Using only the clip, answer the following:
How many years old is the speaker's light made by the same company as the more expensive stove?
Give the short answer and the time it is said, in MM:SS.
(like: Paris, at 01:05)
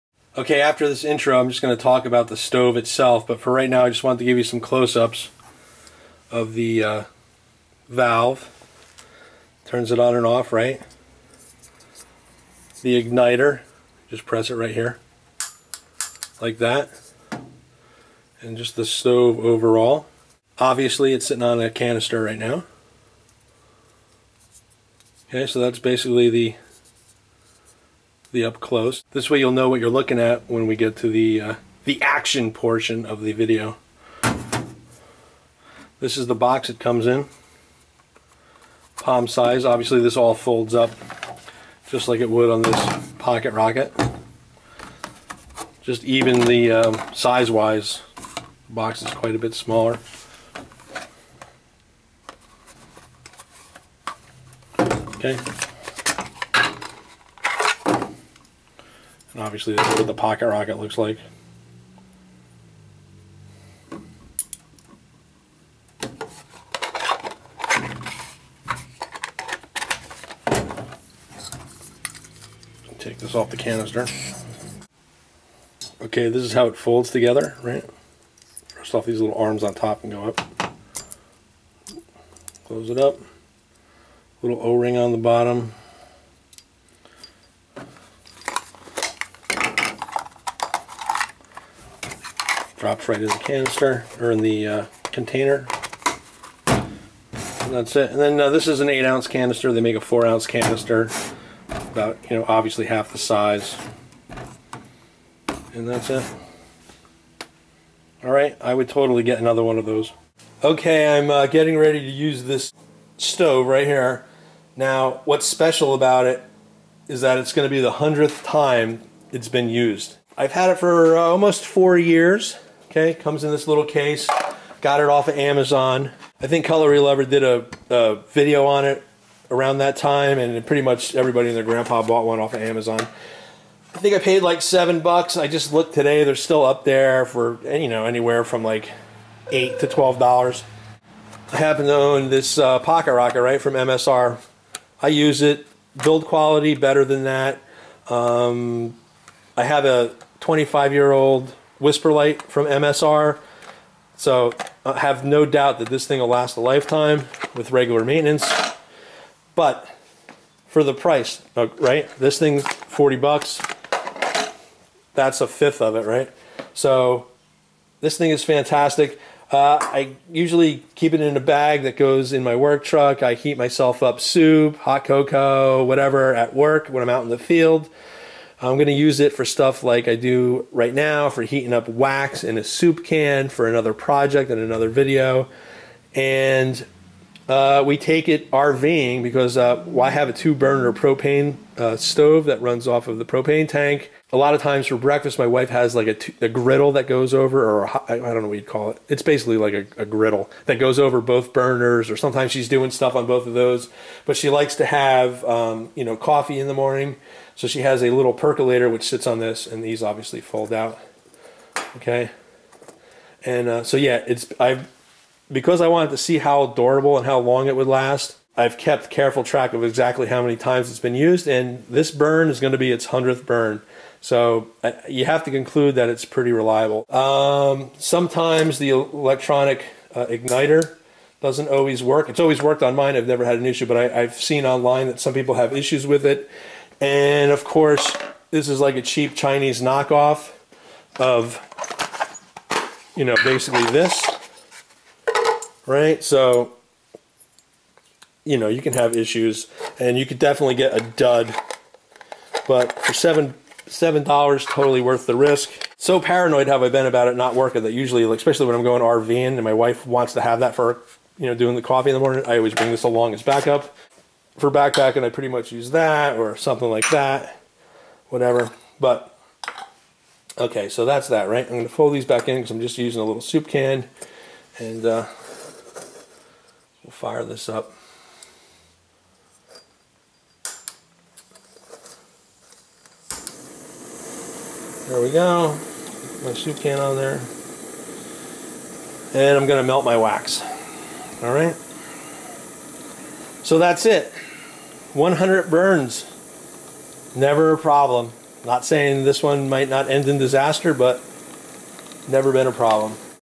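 25, at 02:30.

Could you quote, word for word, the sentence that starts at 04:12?
But for seven seven dollars, totally worth the risk.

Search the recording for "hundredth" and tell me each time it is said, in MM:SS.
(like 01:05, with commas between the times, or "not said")
01:57.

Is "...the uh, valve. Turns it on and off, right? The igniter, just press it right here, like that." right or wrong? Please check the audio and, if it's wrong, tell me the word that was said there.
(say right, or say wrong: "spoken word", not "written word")
right.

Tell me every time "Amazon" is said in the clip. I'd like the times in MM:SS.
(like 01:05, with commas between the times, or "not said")
02:05, 02:12.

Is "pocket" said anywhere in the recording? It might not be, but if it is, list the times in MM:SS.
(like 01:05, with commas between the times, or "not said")
00:43, 01:00, 02:22.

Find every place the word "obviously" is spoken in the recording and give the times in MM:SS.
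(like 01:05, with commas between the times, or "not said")
00:20, 00:39, 00:59, 01:42, 03:30.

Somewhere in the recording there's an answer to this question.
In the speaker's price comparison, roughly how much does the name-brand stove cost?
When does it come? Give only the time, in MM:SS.
02:42.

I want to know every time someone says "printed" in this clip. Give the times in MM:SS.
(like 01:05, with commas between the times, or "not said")
not said.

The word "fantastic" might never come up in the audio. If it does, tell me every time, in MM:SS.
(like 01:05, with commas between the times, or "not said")
02:48.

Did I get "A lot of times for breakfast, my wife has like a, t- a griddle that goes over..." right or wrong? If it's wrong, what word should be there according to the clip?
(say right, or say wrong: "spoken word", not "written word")
right.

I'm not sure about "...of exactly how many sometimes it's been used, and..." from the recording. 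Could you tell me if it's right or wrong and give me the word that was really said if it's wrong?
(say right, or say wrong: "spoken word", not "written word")
wrong: "times", not "sometimes".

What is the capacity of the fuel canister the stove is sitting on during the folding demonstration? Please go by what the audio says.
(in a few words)
8 ounces.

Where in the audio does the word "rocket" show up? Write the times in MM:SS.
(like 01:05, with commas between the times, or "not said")
00:43, 01:00, 02:23.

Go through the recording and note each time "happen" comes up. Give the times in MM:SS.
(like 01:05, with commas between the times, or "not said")
02:21.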